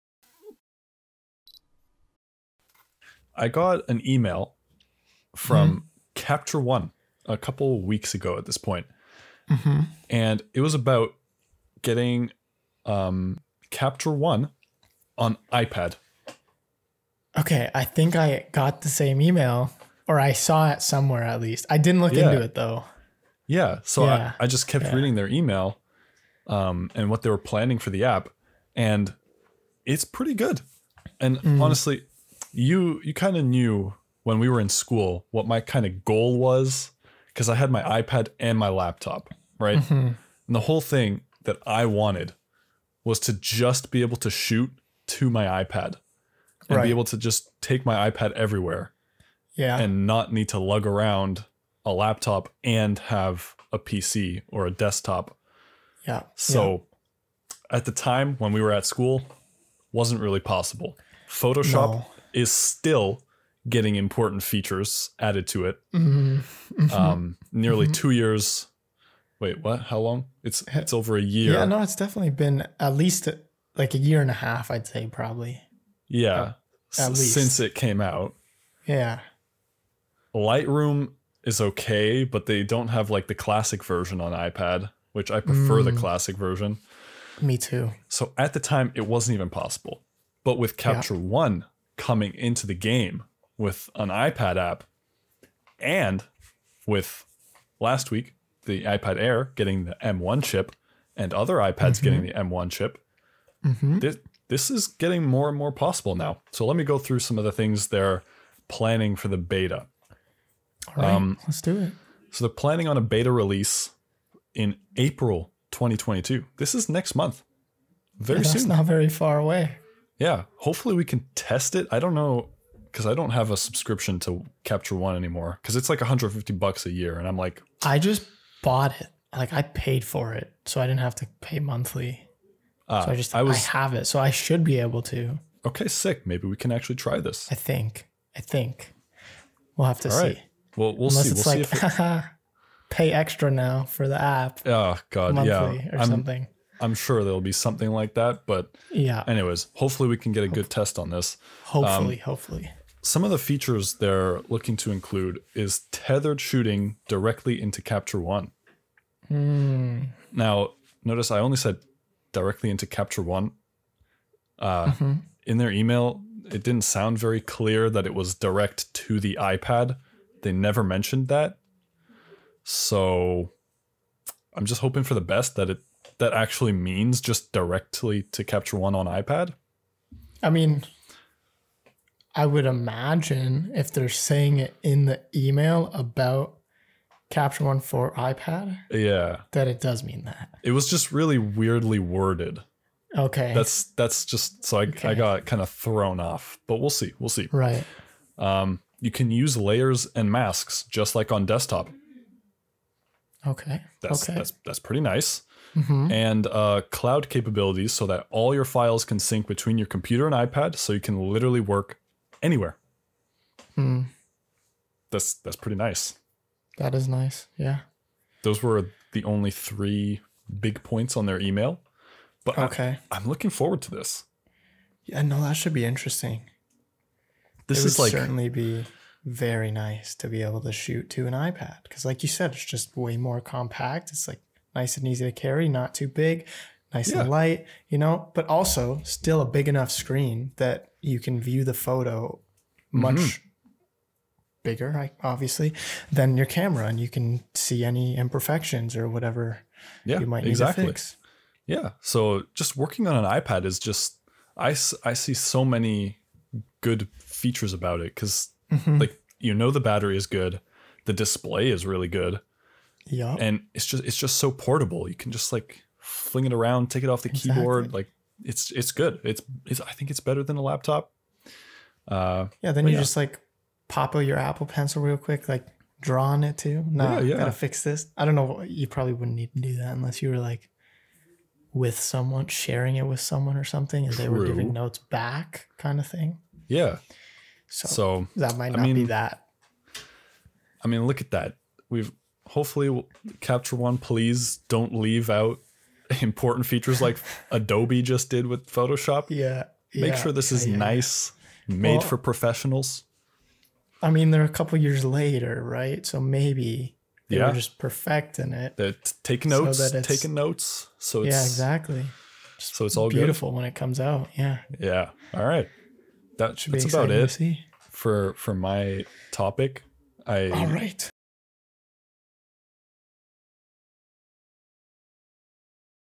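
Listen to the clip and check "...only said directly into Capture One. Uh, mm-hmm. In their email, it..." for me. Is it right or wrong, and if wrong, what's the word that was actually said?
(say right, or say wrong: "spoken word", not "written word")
right.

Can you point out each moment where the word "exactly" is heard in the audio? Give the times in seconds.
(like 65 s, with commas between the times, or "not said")
250 s, 267 s, 311 s.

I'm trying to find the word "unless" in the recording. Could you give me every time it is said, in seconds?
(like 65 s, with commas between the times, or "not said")
141 s, 279 s.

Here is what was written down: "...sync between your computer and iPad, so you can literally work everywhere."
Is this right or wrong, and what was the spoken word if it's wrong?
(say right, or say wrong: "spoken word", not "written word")
wrong: "anywhere", not "everywhere".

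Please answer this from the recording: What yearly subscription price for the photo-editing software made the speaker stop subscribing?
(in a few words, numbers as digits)
150 bucks.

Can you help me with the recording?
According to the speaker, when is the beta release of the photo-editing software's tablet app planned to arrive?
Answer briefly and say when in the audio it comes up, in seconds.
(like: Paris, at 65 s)
April 2022, at 114 s.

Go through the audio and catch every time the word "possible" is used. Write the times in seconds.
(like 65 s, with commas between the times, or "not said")
60 s, 89 s, 105 s.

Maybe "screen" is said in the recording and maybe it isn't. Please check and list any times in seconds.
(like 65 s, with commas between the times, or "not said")
239 s.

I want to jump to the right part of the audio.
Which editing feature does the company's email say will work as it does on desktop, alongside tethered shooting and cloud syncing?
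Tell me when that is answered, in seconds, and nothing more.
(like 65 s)
199 s.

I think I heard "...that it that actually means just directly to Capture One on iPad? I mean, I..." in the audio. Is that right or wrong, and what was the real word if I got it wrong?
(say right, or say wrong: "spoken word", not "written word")
right.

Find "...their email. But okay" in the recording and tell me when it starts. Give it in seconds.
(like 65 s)
221 s.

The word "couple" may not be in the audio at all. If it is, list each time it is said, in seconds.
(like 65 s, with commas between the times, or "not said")
7 s, 304 s.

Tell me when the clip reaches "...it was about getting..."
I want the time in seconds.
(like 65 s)
10 s.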